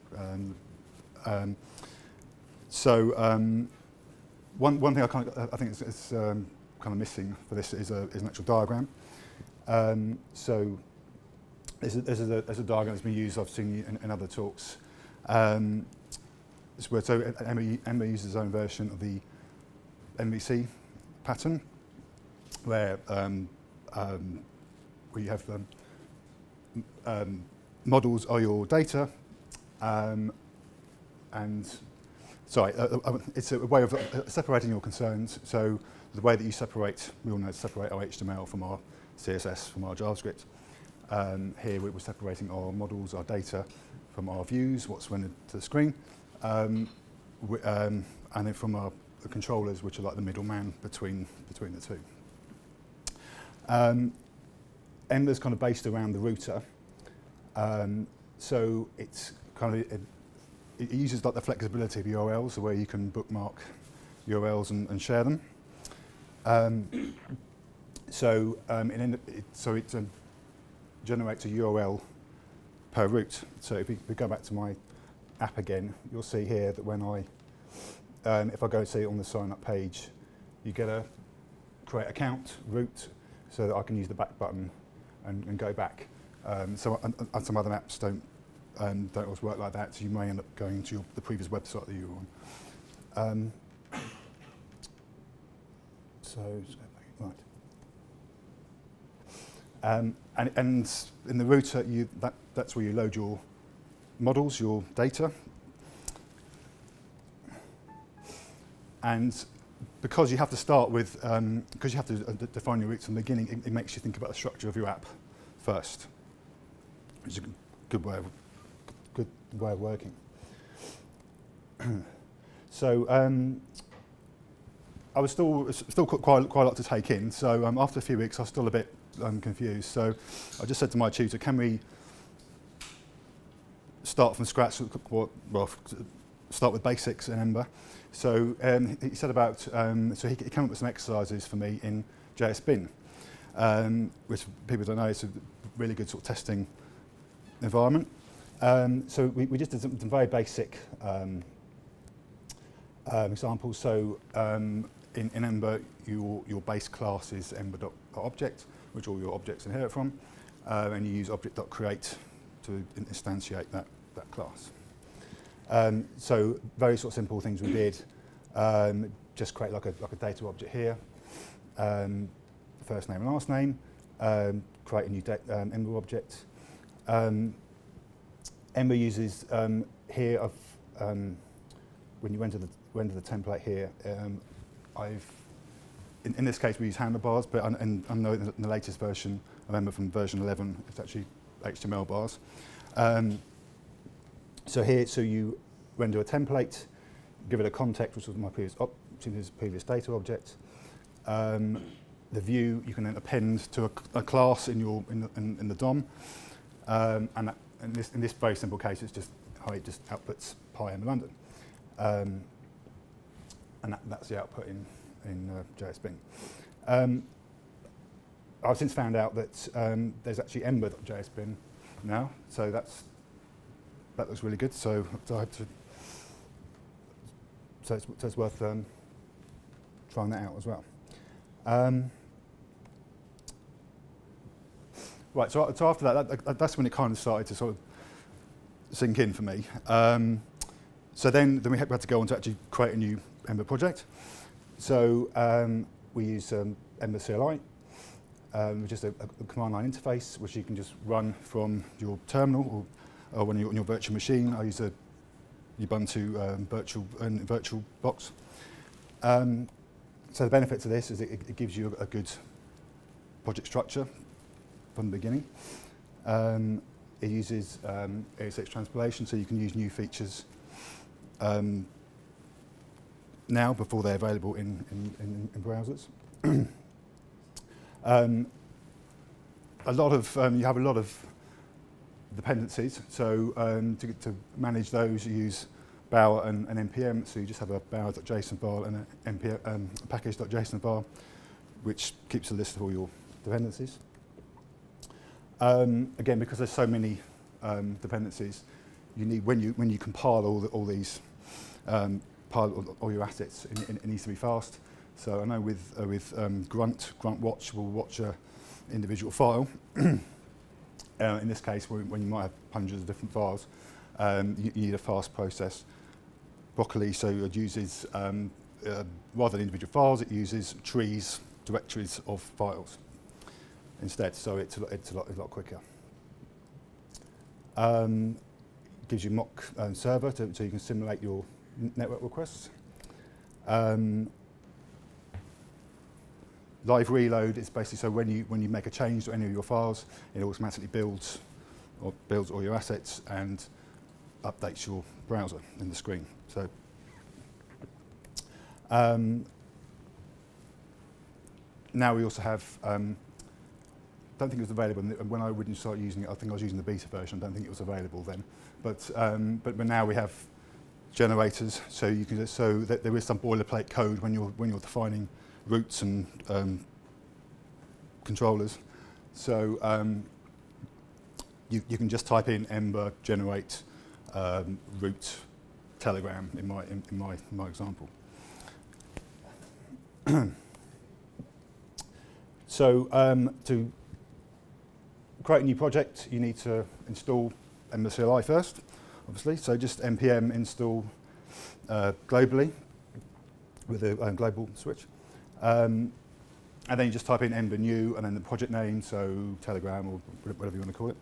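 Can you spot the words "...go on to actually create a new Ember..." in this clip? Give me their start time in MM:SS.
04:02.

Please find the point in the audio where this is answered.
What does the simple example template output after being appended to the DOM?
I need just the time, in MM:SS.
03:30.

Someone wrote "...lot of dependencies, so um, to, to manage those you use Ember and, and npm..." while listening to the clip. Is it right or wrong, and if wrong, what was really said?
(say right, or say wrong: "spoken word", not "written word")
wrong: "Bower", not "Ember".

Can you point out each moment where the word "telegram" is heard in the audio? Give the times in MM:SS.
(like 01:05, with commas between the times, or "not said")
06:15, 06:39.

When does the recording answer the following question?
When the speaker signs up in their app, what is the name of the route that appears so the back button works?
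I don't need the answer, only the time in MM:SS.
01:21.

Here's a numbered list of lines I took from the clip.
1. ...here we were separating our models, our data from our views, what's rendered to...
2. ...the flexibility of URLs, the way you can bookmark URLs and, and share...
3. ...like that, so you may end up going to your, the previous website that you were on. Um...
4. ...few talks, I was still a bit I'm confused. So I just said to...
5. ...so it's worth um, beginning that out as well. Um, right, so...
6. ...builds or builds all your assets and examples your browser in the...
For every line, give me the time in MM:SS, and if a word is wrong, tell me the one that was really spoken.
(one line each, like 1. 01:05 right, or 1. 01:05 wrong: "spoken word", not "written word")
1. 00:41 right
2. 01:01 right
3. 01:29 right
4. 02:08 wrong: "weeks", not "talks"
5. 03:48 wrong: "trying", not "beginning"
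6. 05:40 wrong: "updates", not "examples".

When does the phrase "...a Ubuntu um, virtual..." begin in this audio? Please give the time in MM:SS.
04:14.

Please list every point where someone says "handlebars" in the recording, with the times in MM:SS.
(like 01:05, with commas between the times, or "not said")
03:06.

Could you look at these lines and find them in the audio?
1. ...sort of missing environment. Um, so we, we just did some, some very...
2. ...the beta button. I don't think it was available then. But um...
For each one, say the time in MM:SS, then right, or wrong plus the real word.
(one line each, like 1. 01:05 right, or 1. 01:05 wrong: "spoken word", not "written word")
1. 02:26 wrong: "testing", not "missing"
2. 05:56 wrong: "version", not "button".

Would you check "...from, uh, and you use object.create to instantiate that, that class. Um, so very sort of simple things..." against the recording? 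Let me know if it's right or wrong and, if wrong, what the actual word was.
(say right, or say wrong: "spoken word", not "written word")
right.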